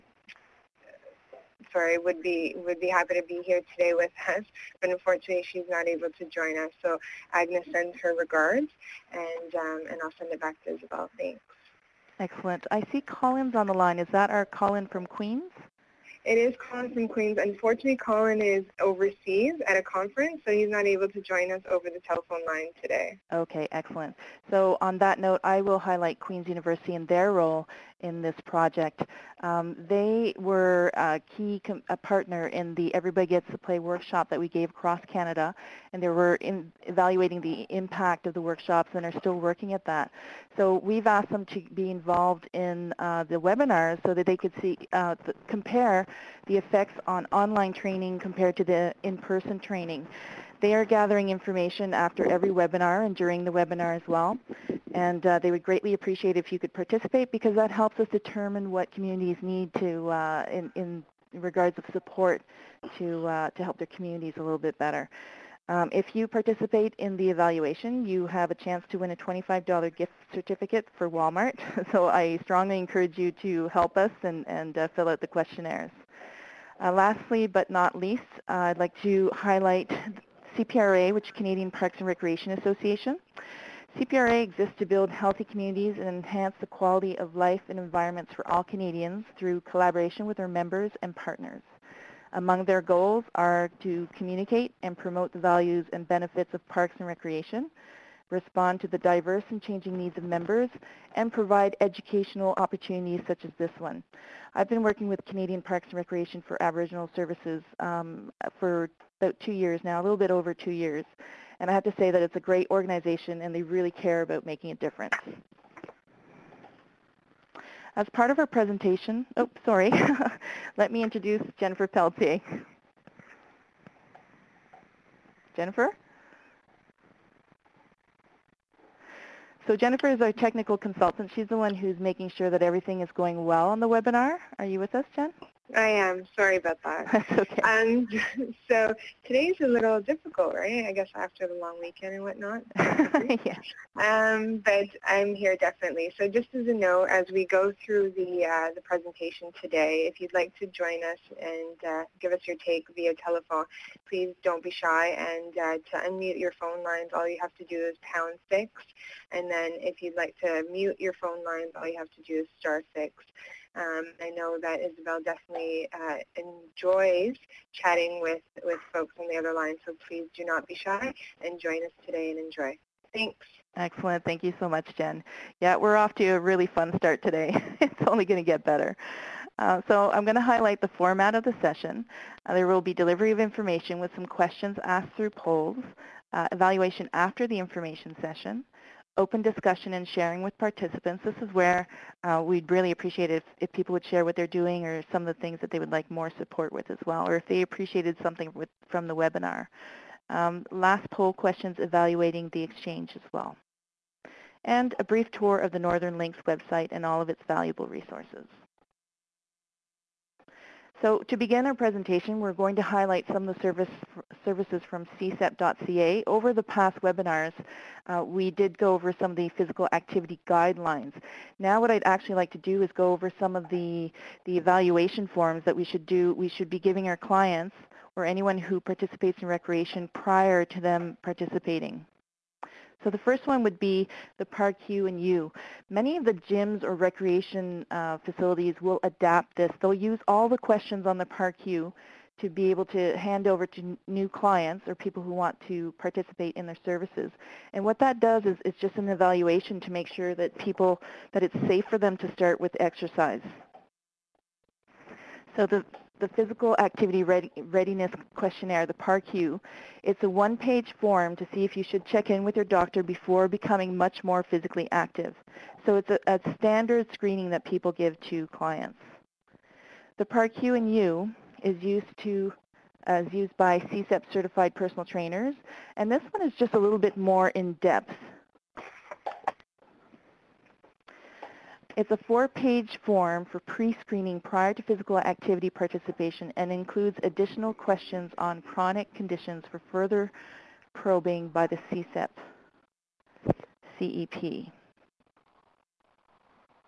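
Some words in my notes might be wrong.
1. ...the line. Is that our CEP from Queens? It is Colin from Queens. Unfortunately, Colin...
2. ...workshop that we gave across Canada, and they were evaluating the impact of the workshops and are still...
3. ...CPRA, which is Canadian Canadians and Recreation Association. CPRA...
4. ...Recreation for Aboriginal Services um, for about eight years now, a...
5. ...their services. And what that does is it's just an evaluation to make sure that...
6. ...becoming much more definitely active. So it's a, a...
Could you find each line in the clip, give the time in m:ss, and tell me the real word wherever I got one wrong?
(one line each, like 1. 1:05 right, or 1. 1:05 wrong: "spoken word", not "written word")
1. 0:13 wrong: "Colin", not "CEP"
2. 0:33 right
3. 1:20 wrong: "Parks", not "Canadians"
4. 1:45 wrong: "two", not "eight"
5. 4:06 right
6. 4:23 wrong: "physically", not "definitely".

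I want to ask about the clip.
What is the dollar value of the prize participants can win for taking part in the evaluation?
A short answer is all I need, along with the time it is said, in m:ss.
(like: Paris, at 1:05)
$25, at 1:09.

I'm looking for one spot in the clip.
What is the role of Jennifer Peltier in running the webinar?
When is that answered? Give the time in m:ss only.
2:10.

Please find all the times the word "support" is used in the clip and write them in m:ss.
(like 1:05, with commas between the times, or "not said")
1:01, 3:16.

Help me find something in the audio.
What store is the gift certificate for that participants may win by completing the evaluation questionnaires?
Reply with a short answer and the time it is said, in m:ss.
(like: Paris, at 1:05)
Walmart, at 1:11.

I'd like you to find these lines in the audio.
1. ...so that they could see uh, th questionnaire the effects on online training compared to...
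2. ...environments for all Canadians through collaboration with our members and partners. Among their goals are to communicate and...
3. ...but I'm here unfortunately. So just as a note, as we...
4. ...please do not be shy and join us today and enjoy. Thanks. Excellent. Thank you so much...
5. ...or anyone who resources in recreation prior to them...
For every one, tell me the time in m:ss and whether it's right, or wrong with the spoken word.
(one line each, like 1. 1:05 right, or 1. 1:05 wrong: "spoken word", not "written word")
1. 0:44 wrong: "compare", not "questionnaire"
2. 1:27 right
3. 2:24 wrong: "definitely", not "unfortunately"
4. 2:50 right
5. 3:48 wrong: "participates", not "resources".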